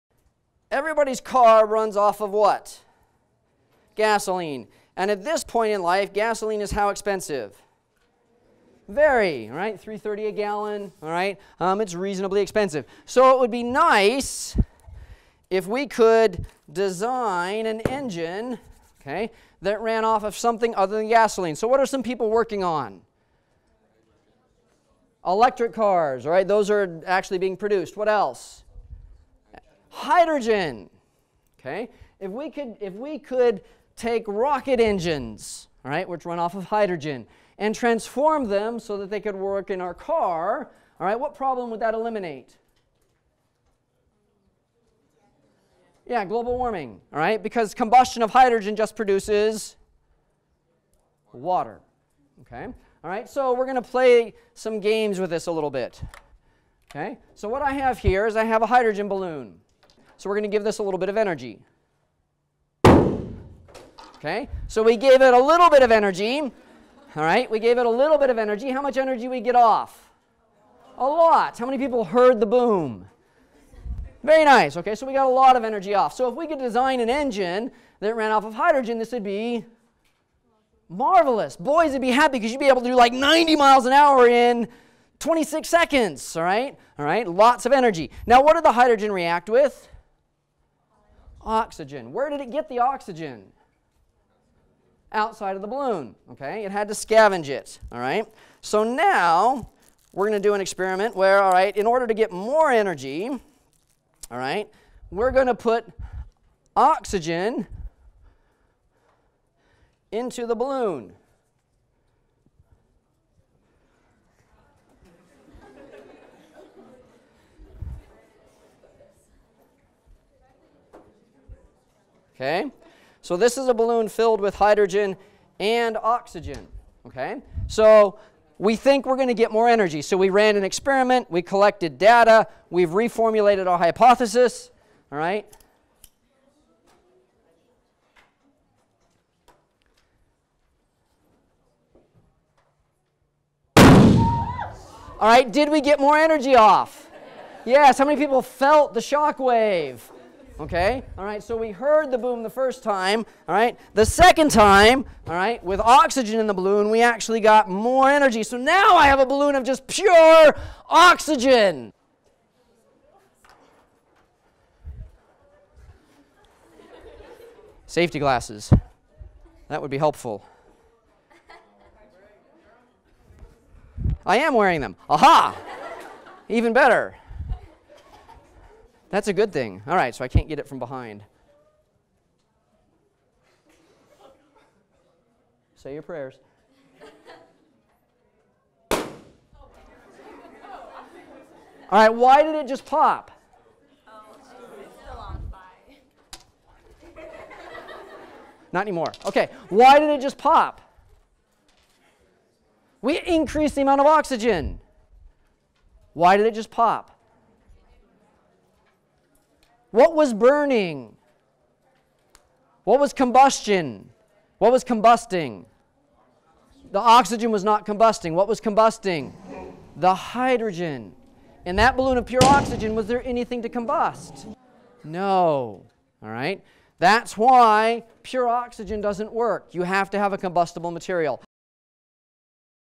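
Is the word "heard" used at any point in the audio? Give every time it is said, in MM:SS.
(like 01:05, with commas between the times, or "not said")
01:12, 02:31.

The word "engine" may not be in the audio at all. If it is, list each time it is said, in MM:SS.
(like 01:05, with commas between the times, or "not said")
00:17, 00:34, 01:17.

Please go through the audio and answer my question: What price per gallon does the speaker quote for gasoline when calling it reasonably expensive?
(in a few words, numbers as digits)
$3.30.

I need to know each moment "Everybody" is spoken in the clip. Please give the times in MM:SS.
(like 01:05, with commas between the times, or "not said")
00:00.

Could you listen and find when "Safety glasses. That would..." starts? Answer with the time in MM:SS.
02:47.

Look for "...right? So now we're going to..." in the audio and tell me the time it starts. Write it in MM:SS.
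01:37.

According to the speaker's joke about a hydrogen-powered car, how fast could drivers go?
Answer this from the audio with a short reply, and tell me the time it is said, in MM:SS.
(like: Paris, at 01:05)
90 miles an hour, at 01:23.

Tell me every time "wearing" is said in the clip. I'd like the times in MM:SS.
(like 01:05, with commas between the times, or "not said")
02:54.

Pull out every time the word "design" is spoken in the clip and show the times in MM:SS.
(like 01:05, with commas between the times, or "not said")
00:16, 01:16.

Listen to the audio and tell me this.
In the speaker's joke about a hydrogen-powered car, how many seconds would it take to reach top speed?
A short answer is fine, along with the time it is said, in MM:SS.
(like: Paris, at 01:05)
26 seconds, at 01:25.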